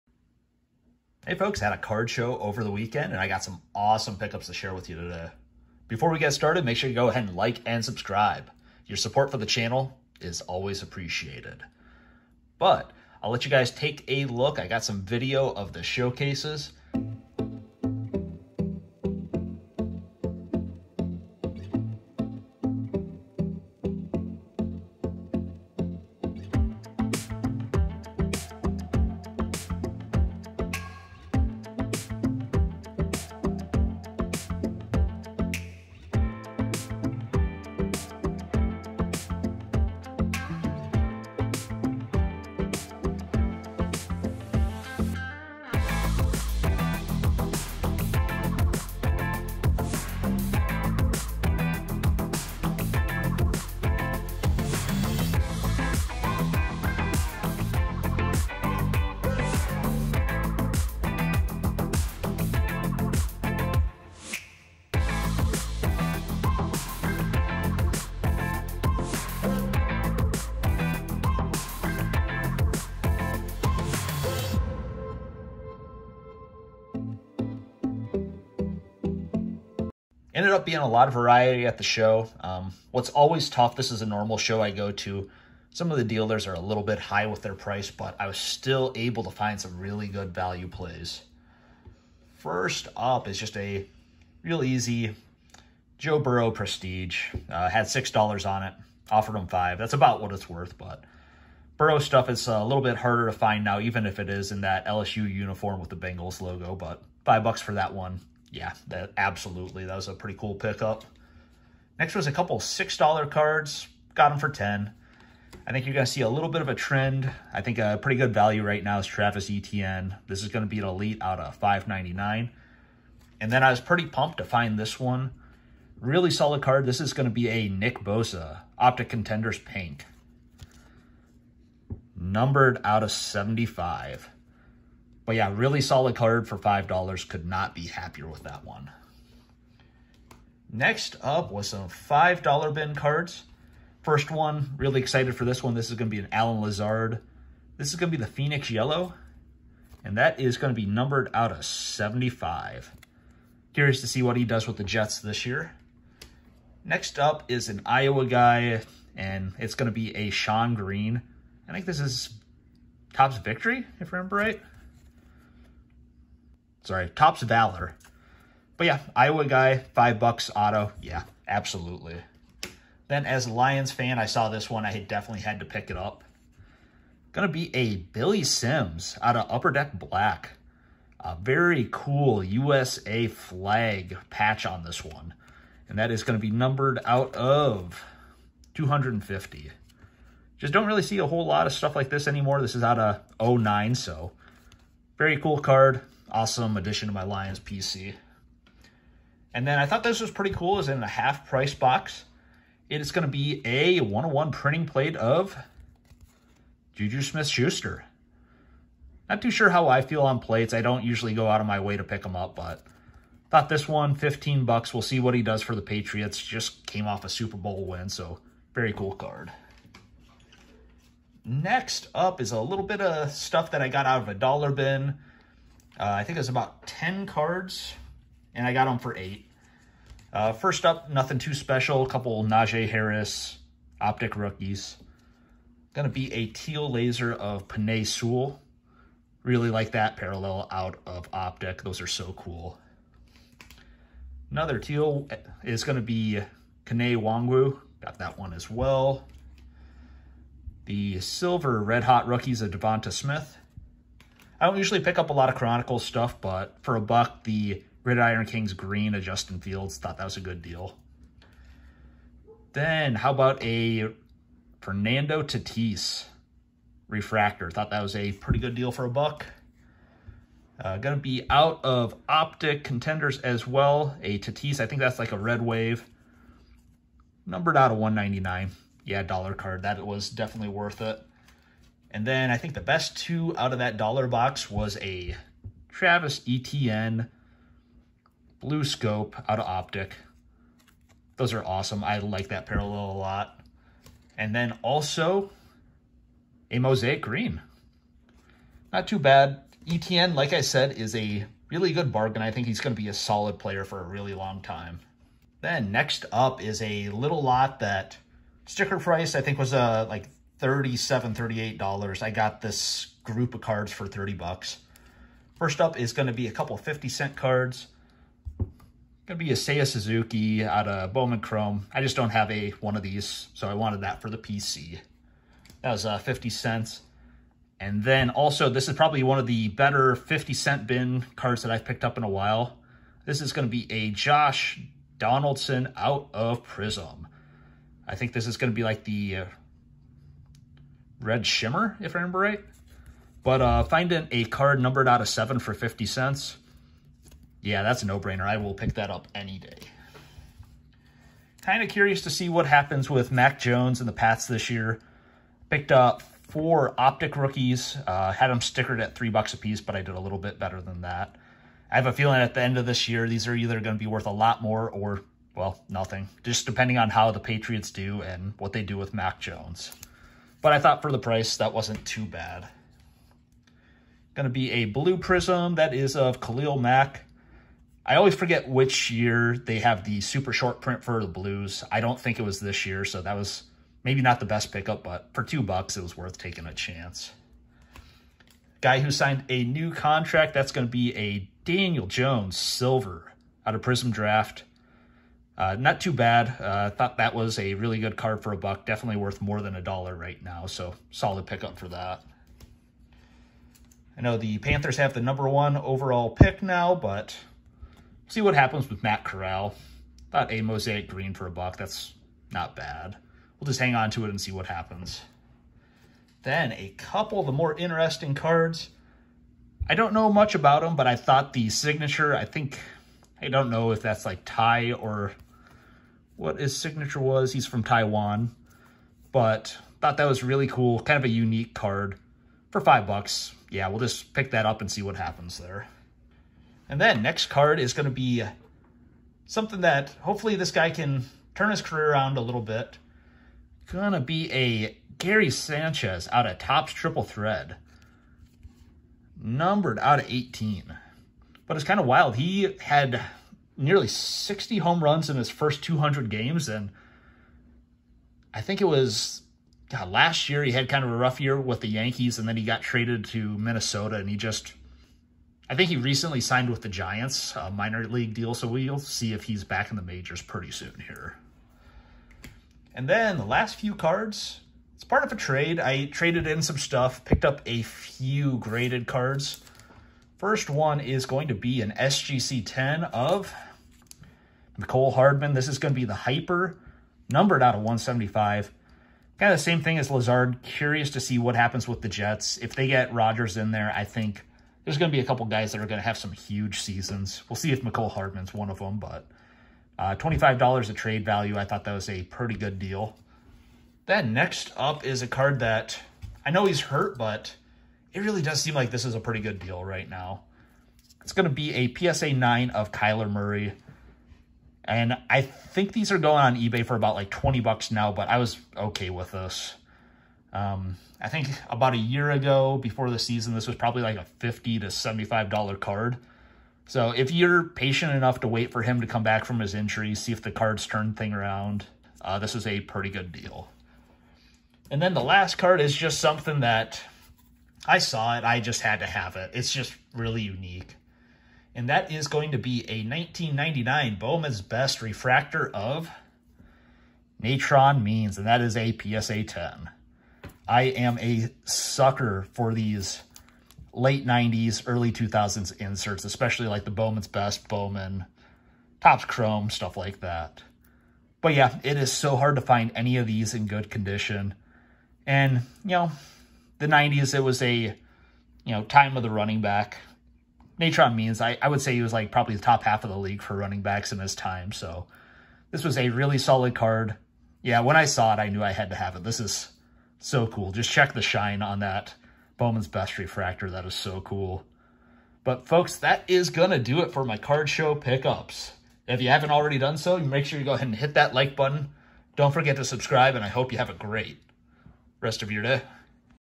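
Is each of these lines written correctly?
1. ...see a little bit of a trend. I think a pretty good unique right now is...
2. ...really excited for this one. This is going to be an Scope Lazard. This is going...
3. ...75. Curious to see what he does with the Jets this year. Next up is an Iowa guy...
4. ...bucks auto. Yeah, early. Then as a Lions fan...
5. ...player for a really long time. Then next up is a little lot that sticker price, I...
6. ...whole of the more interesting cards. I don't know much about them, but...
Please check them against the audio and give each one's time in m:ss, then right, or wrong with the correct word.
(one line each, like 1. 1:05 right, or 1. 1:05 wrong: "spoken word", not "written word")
1. 1:56 wrong: "value", not "unique"
2. 2:24 wrong: "Allen", not "Scope"
3. 2:31 right
4. 2:50 wrong: "absolutely", not "early"
5. 5:03 right
6. 6:56 wrong: "couple", not "whole".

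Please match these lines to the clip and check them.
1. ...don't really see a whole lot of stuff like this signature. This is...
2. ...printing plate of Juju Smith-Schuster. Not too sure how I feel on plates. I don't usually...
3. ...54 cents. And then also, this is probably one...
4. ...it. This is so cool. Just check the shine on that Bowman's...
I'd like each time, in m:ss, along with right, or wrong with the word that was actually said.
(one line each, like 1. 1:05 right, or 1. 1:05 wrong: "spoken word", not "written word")
1. 3:10 wrong: "anymore", not "signature"
2. 3:24 right
3. 5:26 wrong: "50", not "54"
4. 9:39 right.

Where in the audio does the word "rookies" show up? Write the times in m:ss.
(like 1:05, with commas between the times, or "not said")
3:54, 4:12, 5:57.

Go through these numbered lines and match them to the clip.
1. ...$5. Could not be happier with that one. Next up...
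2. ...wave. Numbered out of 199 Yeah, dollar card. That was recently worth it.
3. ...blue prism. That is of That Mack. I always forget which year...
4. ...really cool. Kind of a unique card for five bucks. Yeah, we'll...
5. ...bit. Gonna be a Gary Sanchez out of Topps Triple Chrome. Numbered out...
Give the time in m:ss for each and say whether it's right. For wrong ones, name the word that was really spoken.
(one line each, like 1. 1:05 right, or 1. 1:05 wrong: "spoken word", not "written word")
1. 2:16 right
2. 4:35 wrong: "definitely", not "recently"
3. 6:14 wrong: "Khalil", not "That"
4. 7:10 right
5. 7:22 wrong: "Thread", not "Chrome".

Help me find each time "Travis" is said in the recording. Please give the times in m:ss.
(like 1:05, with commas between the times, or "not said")
1:59, 4:45.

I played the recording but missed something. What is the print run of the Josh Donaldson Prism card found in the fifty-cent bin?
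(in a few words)
7.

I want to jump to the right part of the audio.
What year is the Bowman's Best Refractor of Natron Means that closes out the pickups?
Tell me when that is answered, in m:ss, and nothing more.
9:03.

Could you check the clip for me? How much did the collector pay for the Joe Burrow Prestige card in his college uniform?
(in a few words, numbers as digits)
$5.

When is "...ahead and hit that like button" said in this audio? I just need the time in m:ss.
9:50.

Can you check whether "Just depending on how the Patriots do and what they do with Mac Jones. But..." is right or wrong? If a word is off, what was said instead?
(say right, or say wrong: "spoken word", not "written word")
right.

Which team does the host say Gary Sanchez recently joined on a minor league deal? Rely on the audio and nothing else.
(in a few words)
Giants.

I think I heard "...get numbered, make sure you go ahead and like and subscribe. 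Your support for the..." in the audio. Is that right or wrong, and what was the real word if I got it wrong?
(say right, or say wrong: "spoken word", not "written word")
wrong: "started", not "numbered".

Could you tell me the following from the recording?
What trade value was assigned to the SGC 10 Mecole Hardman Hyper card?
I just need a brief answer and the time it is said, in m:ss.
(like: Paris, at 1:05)
$25, at 8:20.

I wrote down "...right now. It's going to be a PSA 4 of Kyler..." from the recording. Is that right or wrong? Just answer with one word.
wrong.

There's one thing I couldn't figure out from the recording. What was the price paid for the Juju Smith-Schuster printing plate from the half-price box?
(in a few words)
$15.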